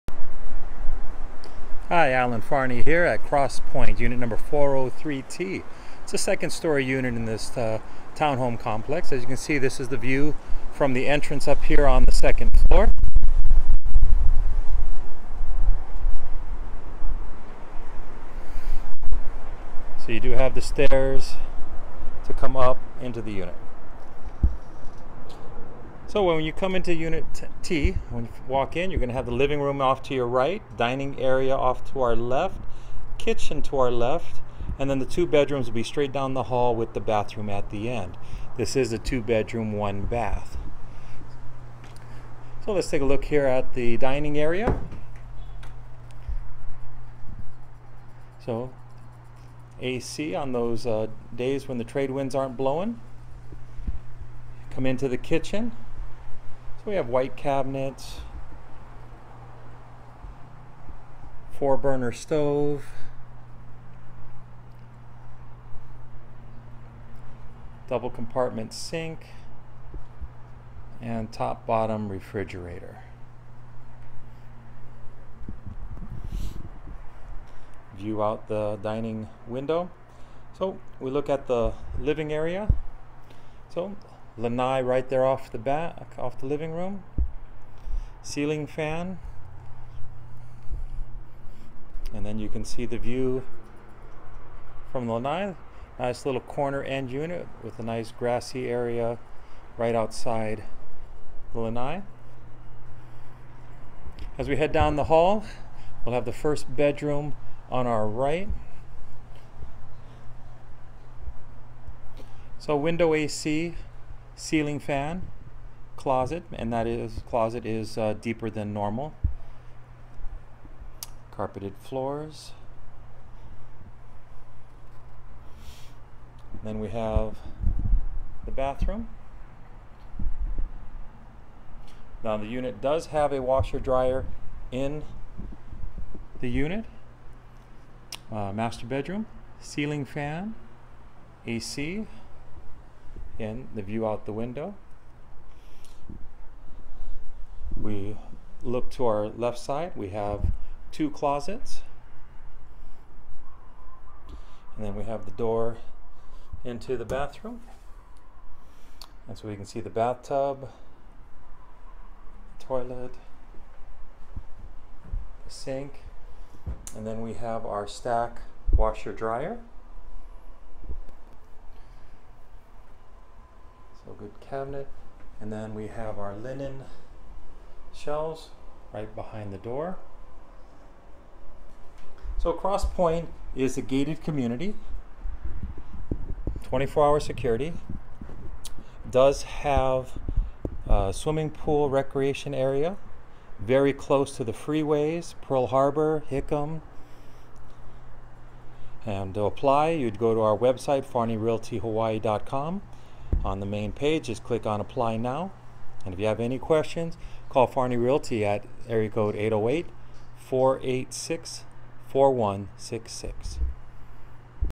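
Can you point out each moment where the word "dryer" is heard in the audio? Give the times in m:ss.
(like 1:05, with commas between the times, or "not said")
2:13, 2:49.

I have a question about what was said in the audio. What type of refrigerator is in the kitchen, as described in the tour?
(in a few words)
Top bottom refrigerator.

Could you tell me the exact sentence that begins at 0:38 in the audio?
This is a two bedroom, one bath.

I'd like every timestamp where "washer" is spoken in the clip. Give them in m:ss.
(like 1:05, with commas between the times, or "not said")
2:13, 2:48.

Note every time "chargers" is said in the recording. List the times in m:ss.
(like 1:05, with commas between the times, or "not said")
not said.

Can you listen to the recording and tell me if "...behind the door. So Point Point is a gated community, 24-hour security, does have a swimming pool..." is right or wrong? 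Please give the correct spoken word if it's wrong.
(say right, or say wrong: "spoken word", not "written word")
wrong: "Cross", not "Point".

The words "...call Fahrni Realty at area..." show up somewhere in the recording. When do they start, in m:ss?
3:27.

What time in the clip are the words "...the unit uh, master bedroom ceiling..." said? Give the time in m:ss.
2:16.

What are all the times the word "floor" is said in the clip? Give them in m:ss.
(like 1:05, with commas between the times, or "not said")
0:12, 2:01.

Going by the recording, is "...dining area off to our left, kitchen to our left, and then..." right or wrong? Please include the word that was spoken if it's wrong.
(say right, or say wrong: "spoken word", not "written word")
right.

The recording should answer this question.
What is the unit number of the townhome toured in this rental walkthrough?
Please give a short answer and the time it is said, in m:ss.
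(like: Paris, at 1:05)
403T, at 0:04.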